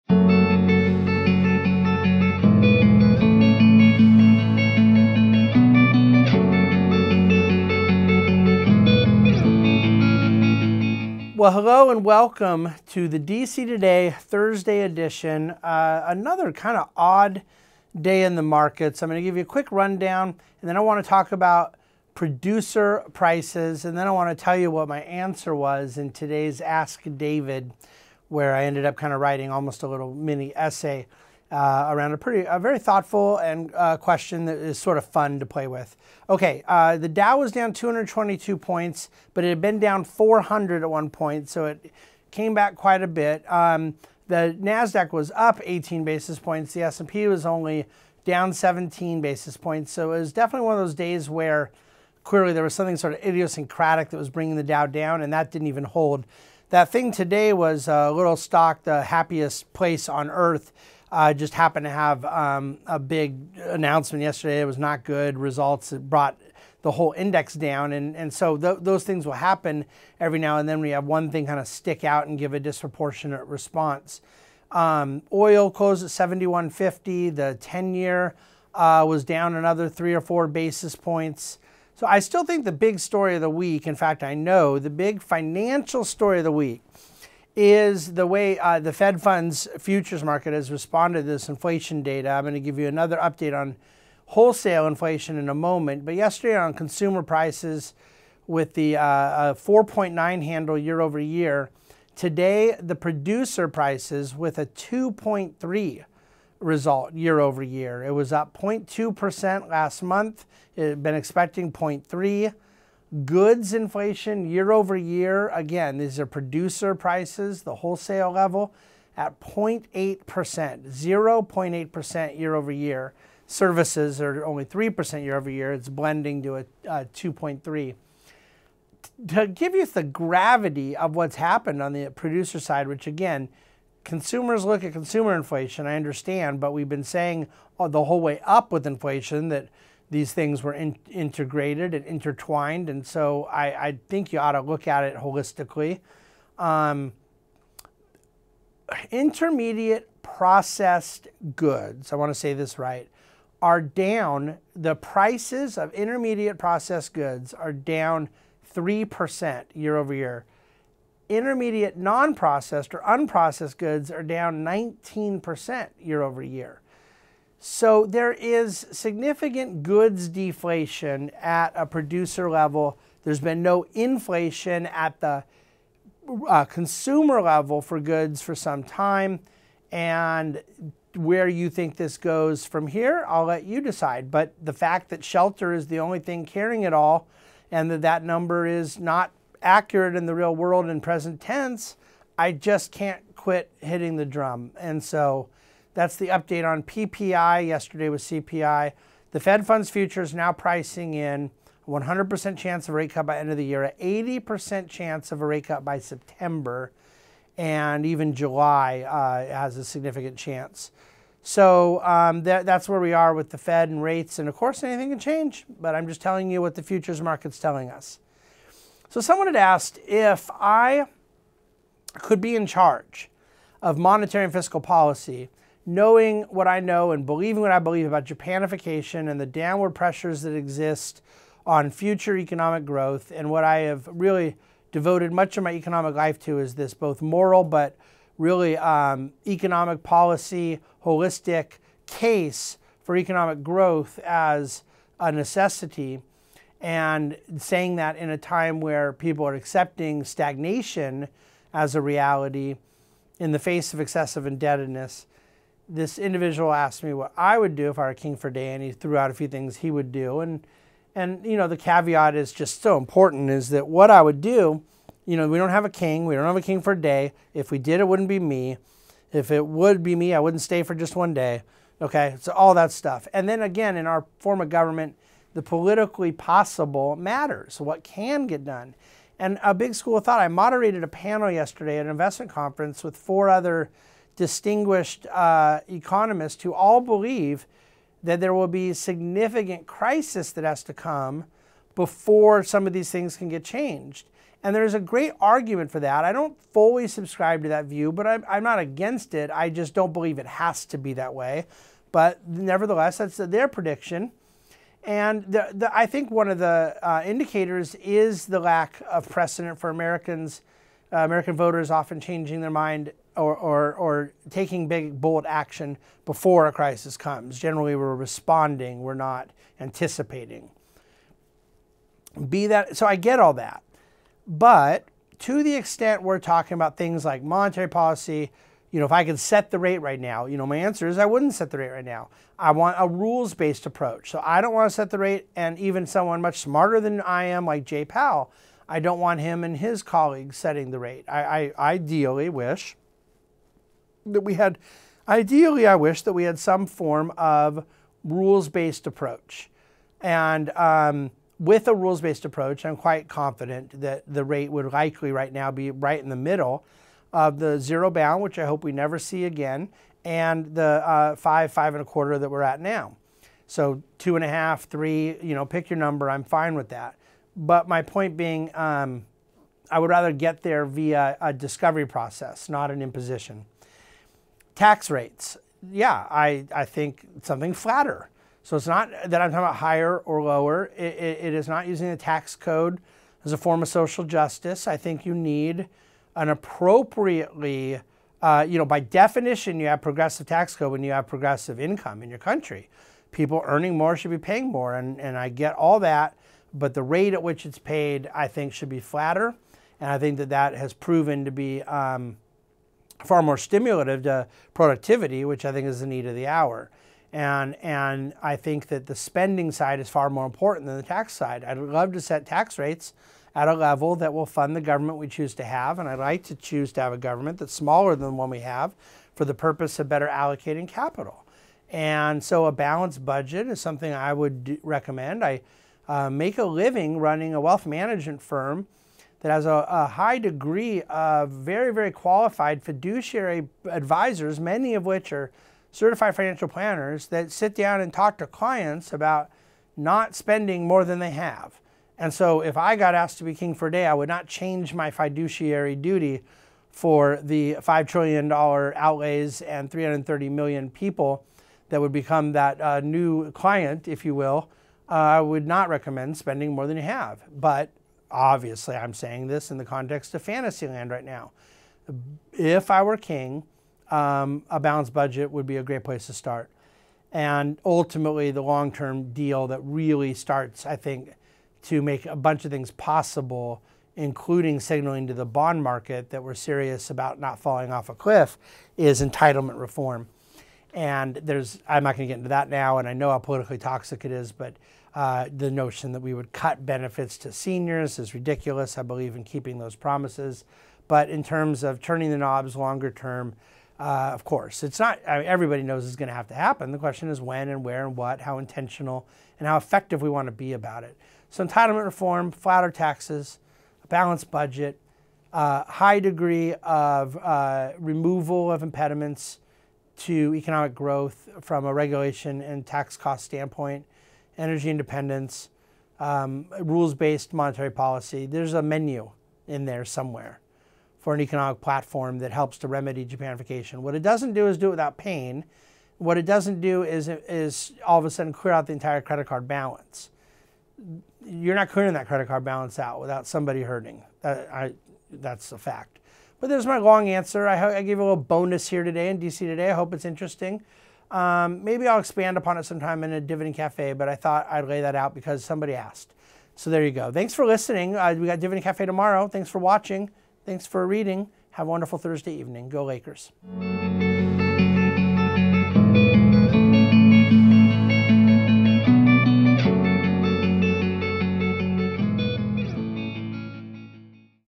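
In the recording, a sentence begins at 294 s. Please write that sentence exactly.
And there's a great argument for that.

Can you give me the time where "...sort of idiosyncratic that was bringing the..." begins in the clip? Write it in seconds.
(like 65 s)
52 s.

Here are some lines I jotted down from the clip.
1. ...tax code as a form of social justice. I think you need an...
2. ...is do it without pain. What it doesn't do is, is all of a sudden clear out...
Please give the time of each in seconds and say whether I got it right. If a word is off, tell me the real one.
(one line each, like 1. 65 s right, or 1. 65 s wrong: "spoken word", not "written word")
1. 382 s right
2. 524 s right.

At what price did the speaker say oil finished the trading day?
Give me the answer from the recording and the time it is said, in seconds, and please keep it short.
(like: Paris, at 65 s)
71.50, at 76 s.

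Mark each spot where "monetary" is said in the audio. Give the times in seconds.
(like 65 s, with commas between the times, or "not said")
223 s, 327 s, 517 s.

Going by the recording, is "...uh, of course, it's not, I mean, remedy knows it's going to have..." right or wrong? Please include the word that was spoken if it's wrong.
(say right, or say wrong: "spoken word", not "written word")
wrong: "everybody", not "remedy".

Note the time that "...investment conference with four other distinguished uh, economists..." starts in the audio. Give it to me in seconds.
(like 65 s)
282 s.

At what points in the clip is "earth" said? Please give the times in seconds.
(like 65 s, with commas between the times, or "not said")
60 s.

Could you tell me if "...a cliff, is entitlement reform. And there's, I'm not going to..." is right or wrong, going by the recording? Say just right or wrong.
right.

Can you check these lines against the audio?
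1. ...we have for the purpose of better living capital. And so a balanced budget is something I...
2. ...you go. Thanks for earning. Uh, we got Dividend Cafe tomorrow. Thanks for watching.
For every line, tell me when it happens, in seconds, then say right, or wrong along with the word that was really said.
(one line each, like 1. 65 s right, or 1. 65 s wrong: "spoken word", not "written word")
1. 418 s wrong: "allocating", not "living"
2. 547 s wrong: "listening", not "earning".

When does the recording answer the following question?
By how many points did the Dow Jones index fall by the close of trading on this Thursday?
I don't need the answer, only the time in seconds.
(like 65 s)
37 s.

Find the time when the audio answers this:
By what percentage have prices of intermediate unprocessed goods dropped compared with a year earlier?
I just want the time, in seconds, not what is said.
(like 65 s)
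164 s.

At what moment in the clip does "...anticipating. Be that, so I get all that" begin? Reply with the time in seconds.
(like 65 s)
319 s.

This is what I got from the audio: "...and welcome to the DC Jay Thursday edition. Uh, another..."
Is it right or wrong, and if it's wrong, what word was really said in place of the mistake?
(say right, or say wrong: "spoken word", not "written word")
wrong: "Today", not "Jay".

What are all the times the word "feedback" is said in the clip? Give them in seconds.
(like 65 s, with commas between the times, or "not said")
not said.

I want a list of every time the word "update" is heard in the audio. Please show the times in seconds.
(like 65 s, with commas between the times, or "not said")
93 s, 196 s.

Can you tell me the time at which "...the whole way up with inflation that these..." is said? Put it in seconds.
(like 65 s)
137 s.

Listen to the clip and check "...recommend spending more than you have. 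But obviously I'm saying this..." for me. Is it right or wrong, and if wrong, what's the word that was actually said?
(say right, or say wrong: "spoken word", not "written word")
right.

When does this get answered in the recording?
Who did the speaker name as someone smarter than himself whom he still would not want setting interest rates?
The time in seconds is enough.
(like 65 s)
337 s.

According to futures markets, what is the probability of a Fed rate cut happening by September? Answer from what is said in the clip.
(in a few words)
80%.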